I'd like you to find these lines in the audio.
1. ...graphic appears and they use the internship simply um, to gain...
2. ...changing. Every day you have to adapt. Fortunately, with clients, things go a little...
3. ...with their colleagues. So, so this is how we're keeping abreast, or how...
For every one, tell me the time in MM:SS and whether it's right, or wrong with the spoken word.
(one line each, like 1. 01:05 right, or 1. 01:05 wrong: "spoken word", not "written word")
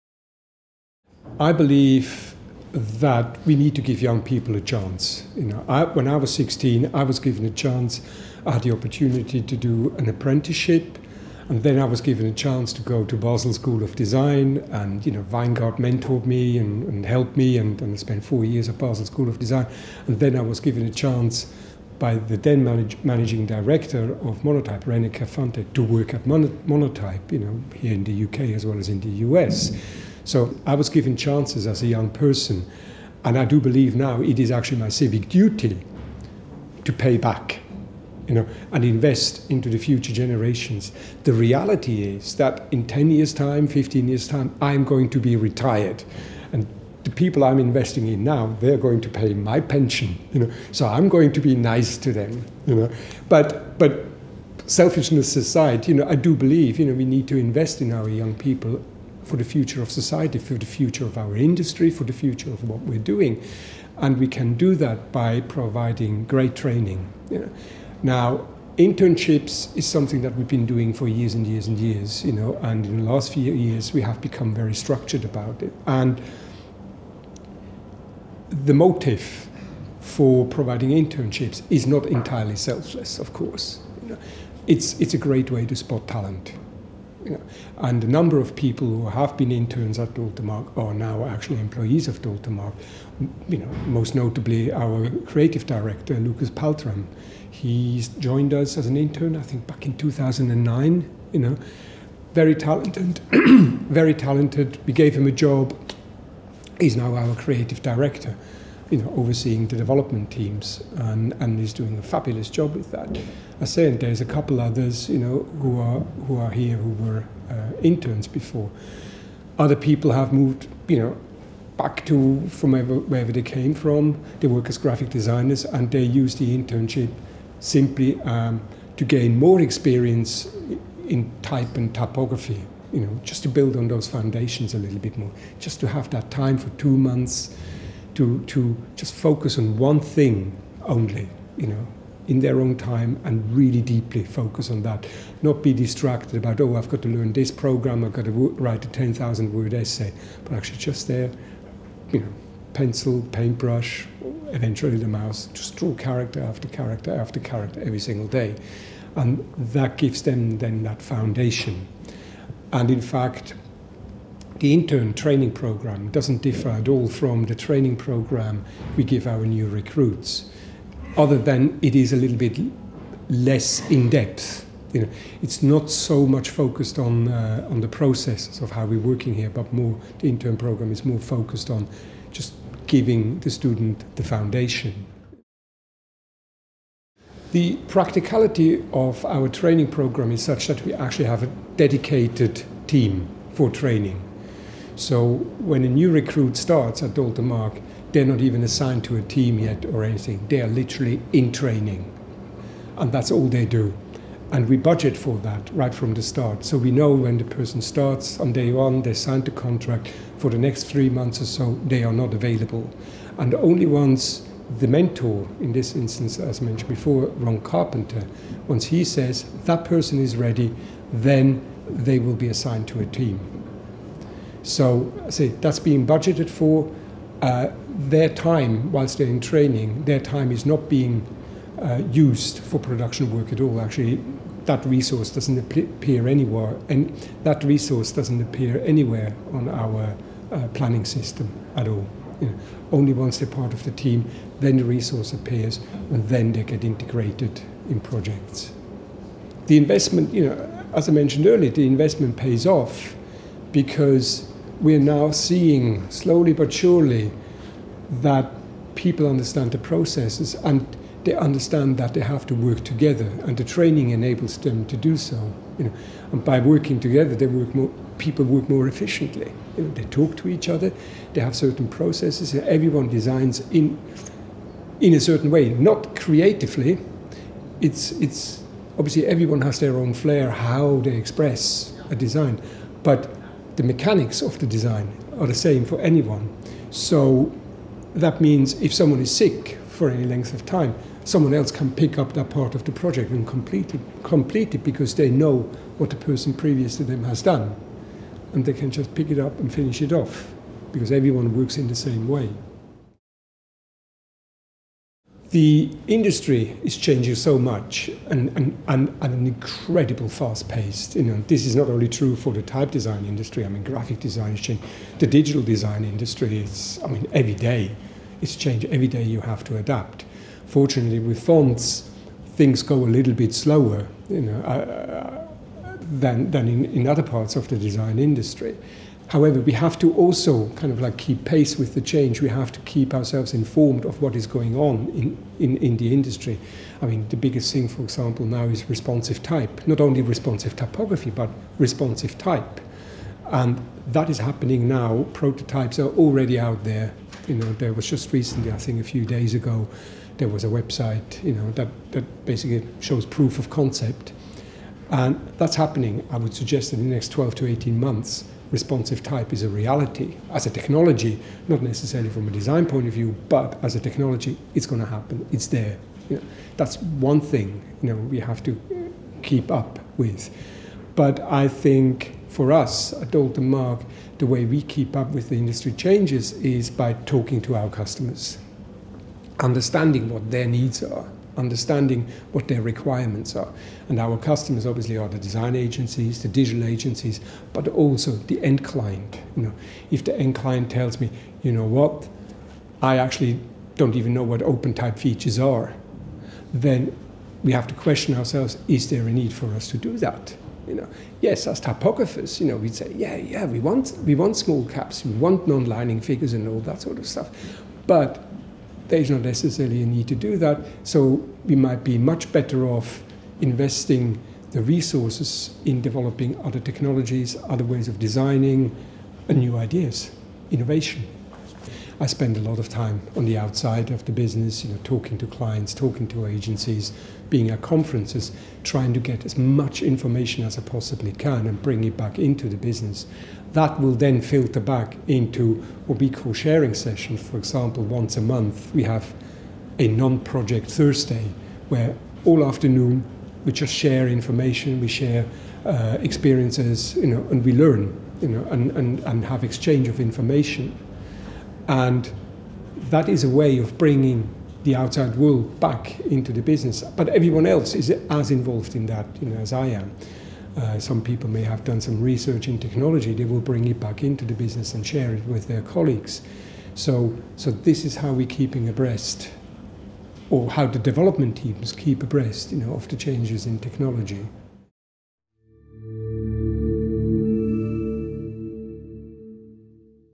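1. 02:04 wrong: "designers", not "appears"
2. 05:18 wrong: "fonts", not "clients"
3. 07:45 right.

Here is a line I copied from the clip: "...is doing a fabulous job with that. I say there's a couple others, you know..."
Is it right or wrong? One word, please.
right.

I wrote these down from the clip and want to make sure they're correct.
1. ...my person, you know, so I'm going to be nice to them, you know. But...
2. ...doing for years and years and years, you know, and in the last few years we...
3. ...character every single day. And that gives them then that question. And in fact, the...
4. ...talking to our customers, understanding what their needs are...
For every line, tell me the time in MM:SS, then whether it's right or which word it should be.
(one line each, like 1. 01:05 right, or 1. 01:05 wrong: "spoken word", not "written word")
1. 00:49 wrong: "pension", not "person"
2. 01:10 right
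3. 02:37 wrong: "foundation", not "question"
4. 06:17 right.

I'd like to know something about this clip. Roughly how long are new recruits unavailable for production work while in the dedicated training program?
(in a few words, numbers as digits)
3 months.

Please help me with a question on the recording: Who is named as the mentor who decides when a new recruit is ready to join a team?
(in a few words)
Ron Carpenter.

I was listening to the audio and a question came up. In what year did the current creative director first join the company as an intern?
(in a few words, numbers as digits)
2009.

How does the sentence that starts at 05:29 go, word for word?
However, we have to also kind of like keep pace with the change.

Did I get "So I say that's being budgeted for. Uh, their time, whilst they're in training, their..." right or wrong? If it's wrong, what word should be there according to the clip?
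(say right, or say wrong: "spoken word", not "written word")
right.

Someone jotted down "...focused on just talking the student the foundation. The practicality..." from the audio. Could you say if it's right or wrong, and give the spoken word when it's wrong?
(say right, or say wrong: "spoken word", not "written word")
wrong: "giving", not "talking".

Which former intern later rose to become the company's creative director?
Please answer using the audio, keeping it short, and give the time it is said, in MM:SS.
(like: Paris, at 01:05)
Lucas Paltram, at 01:36.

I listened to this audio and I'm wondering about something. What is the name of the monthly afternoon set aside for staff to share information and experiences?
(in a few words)
non-project Thursday.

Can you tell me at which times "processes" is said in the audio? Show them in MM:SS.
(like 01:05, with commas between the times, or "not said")
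02:57, 04:19, 04:31.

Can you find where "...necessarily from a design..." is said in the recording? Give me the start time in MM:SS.
06:01.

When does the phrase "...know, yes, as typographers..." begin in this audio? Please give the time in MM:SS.
06:40.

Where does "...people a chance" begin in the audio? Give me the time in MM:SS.
00:04.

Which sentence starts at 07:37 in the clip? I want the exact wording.
But everyone else is as involved in that you know, as I am.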